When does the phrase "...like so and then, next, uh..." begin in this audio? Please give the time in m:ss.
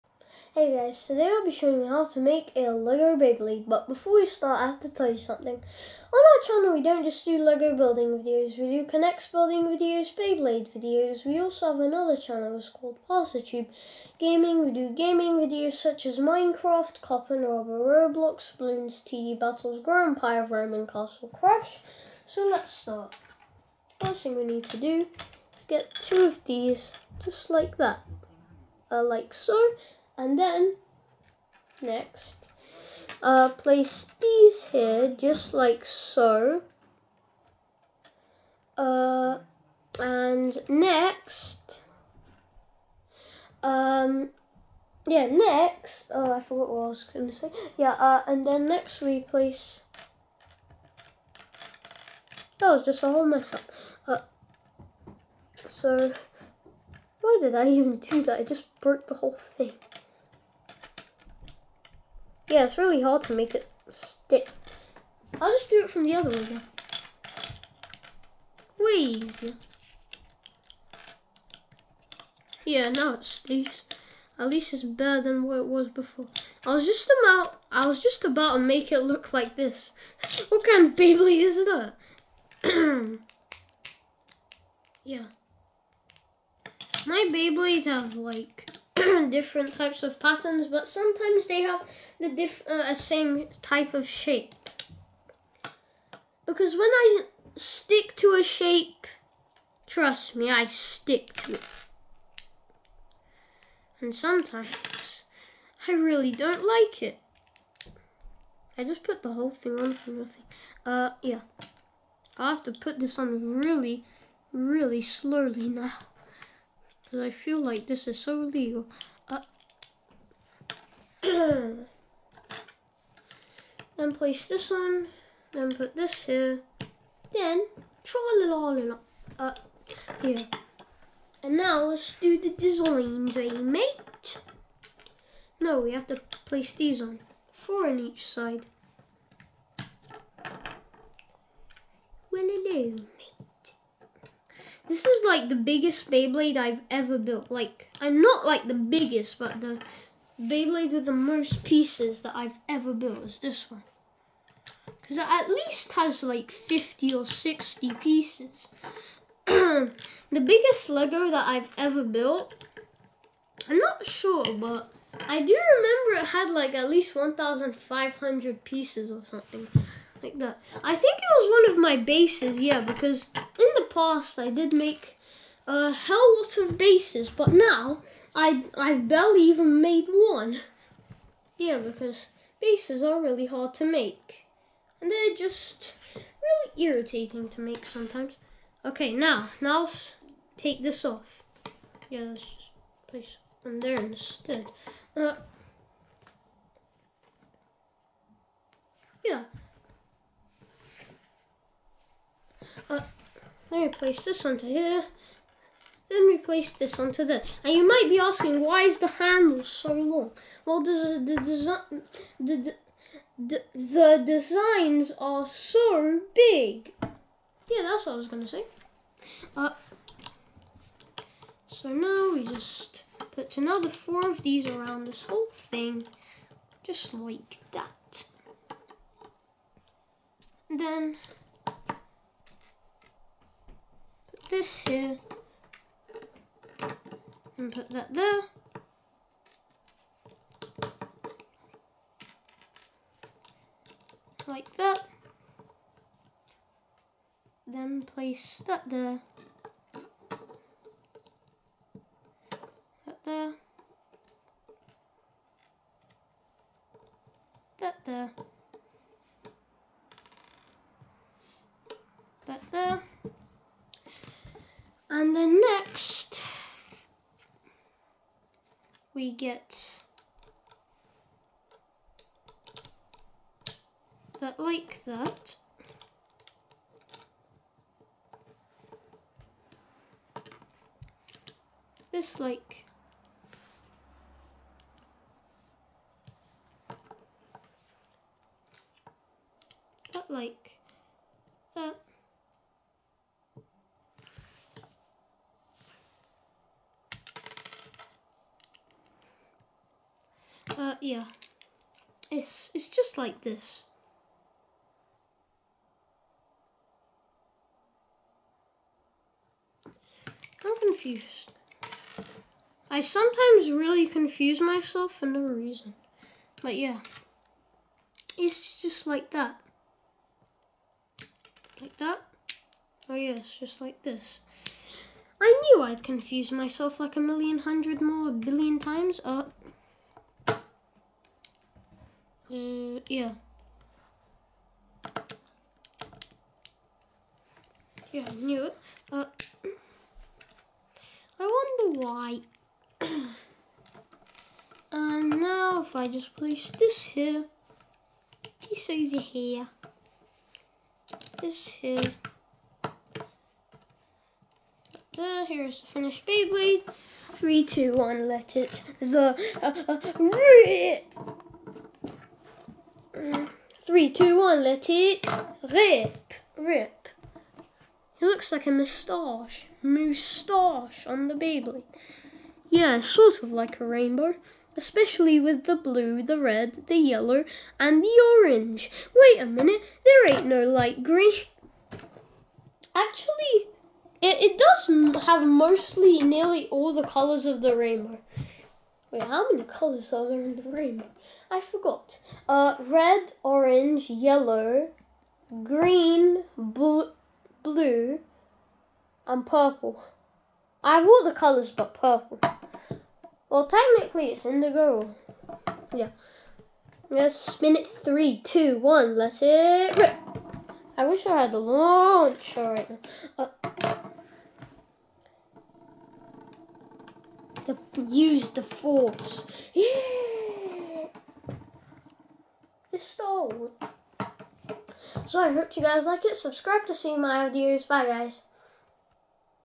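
0:29.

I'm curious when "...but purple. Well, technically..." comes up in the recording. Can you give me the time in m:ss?
6:41.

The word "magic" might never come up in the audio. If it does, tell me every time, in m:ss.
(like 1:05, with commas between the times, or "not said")
not said.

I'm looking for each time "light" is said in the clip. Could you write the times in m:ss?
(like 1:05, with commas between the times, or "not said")
6:20.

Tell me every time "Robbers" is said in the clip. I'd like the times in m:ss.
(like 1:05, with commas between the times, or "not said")
0:17.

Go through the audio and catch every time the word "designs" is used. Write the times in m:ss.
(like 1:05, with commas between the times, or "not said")
2:12, 3:34.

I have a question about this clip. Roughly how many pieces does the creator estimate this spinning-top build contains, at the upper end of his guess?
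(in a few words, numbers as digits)
60.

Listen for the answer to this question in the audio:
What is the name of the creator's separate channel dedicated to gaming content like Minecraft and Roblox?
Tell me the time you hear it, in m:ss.
0:13.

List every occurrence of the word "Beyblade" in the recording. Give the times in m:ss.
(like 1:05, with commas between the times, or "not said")
0:03, 0:10, 1:20, 1:27, 2:26, 2:30, 5:56.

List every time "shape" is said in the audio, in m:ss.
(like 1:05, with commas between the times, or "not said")
1:34, 1:38.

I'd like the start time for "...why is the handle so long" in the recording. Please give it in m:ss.
3:28.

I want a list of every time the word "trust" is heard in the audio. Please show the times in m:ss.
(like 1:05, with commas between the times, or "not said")
1:39.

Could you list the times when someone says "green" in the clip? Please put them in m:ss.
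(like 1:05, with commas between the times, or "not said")
6:21, 6:35.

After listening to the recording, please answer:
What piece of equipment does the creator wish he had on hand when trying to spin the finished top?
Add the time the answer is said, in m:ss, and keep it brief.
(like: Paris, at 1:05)
the launcher, at 6:51.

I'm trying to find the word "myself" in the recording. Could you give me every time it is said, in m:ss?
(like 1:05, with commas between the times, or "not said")
5:14, 5:26.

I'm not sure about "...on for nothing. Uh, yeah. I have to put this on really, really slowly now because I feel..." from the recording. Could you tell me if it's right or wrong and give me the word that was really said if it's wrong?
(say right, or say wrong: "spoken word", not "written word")
right.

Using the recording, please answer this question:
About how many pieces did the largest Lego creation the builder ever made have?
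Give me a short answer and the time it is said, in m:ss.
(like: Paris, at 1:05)
1,500, at 2:47.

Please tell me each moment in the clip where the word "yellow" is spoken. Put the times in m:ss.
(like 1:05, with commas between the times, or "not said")
6:16, 6:34.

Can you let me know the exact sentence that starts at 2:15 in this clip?
No, we have to place these on, four on each side.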